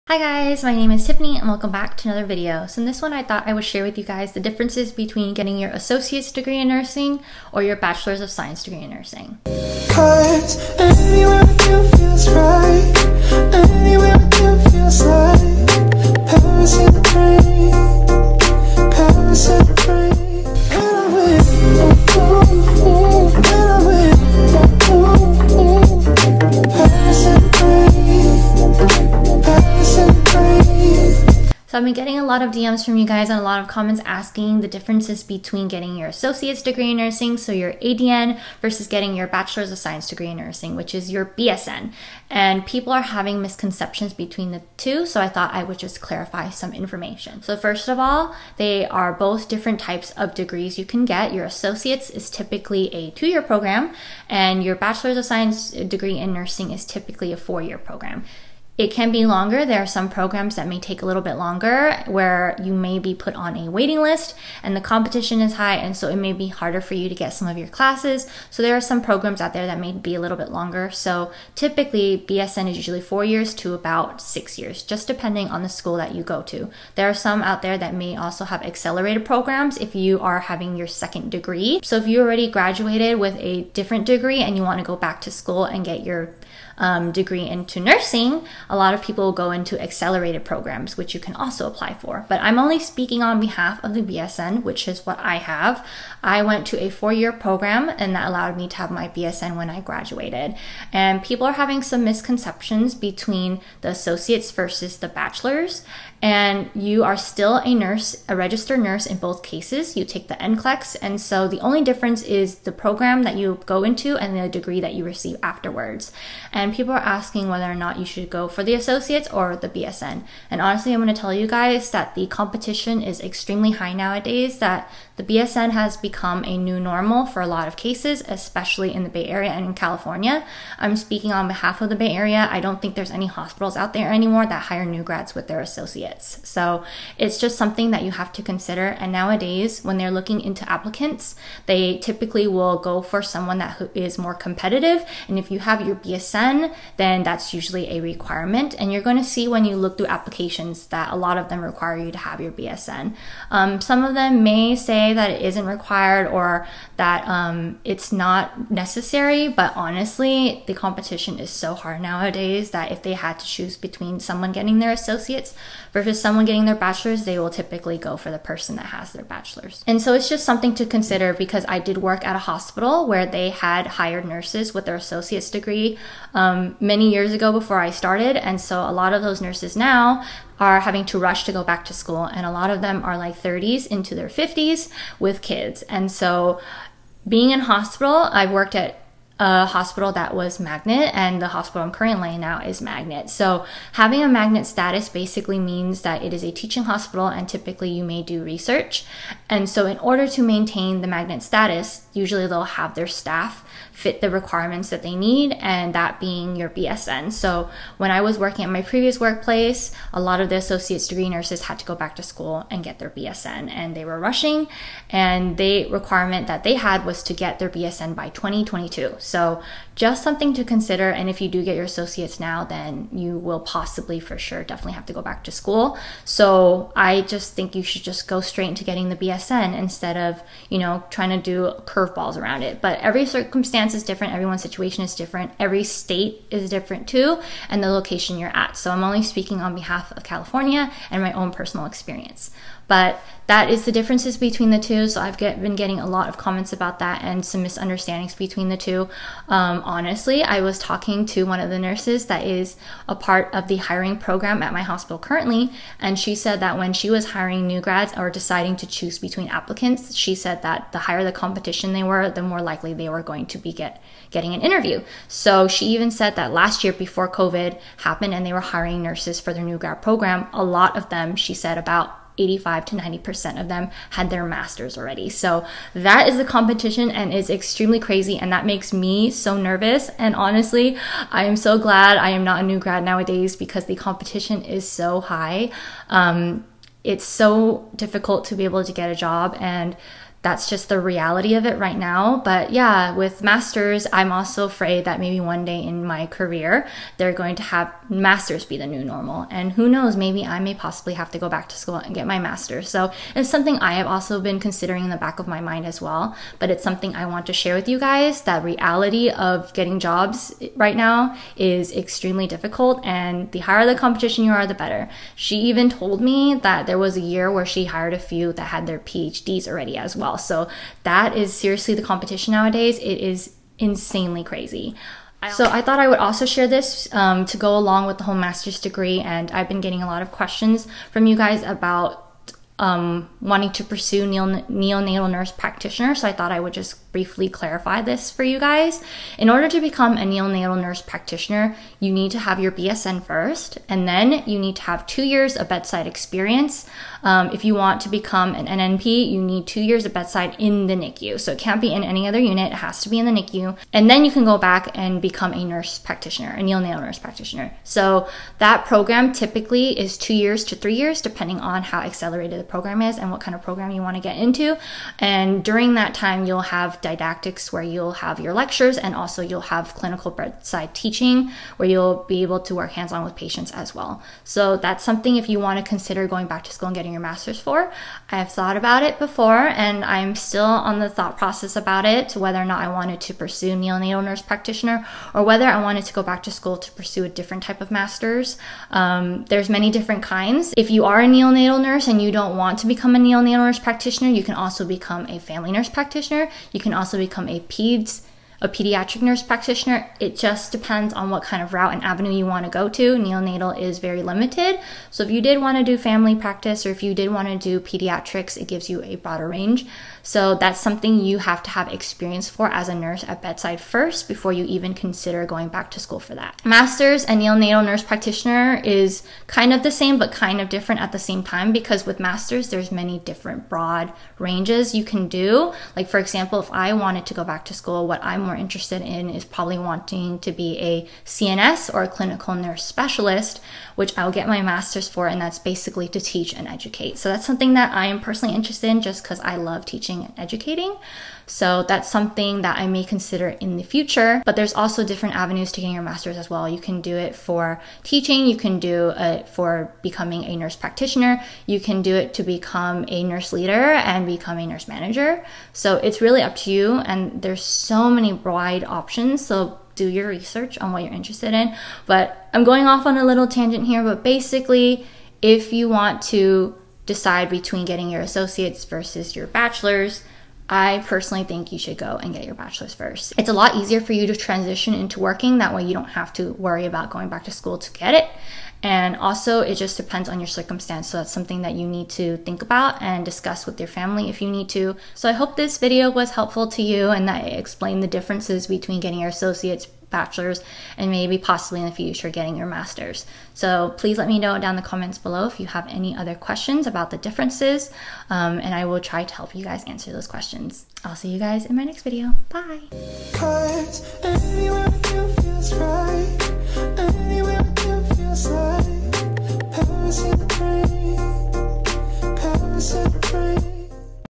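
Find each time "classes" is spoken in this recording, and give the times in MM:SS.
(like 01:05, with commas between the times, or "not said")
01:07.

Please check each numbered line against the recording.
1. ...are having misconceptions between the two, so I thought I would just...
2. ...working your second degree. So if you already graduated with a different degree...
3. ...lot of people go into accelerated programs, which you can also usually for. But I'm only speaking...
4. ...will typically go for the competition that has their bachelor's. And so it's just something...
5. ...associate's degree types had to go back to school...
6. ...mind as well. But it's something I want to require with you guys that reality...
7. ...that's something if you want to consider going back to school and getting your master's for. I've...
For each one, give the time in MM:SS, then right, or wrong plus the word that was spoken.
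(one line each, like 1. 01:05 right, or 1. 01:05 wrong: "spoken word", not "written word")
1. 00:42 right
2. 01:20 wrong: "having", not "working"
3. 01:28 wrong: "apply", not "usually"
4. 02:47 wrong: "person", not "competition"
5. 03:30 wrong: "nurses", not "types"
6. 05:05 wrong: "share", not "require"
7. 06:14 right.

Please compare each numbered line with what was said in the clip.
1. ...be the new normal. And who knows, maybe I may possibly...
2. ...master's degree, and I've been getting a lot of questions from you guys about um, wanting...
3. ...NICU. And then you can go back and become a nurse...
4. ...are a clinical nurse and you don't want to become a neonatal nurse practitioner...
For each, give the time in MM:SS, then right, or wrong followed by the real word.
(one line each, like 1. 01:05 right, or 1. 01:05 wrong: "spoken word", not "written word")
1. 04:58 right
2. 05:28 right
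3. 05:53 right
4. 06:31 wrong: "neonatal", not "clinical".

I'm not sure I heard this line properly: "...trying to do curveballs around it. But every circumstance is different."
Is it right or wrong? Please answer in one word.
right.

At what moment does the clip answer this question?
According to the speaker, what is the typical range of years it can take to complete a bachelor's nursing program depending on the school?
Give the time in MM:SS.
01:13.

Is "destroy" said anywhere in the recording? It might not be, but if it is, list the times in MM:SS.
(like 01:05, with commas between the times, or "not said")
not said.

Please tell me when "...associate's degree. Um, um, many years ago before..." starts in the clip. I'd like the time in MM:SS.
02:54.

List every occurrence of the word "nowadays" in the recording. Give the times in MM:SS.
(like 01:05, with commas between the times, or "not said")
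02:03, 02:19, 02:42, 04:43, 05:22.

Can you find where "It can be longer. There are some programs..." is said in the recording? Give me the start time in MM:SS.
00:58.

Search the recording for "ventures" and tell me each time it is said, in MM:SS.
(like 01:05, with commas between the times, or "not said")
not said.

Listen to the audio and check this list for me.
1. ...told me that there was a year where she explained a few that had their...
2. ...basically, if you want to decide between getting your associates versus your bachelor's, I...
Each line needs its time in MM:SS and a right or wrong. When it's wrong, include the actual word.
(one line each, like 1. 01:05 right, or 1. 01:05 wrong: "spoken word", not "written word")
1. 05:15 wrong: "hired", not "explained"
2. 07:44 right.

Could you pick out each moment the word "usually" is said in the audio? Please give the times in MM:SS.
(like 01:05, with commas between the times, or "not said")
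01:12, 02:27, 03:22.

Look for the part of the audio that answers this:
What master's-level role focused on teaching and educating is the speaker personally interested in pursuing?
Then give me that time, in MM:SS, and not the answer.
07:12.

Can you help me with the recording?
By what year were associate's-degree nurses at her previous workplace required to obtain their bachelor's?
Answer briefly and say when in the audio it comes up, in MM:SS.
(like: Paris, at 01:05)
2022, at 03:38.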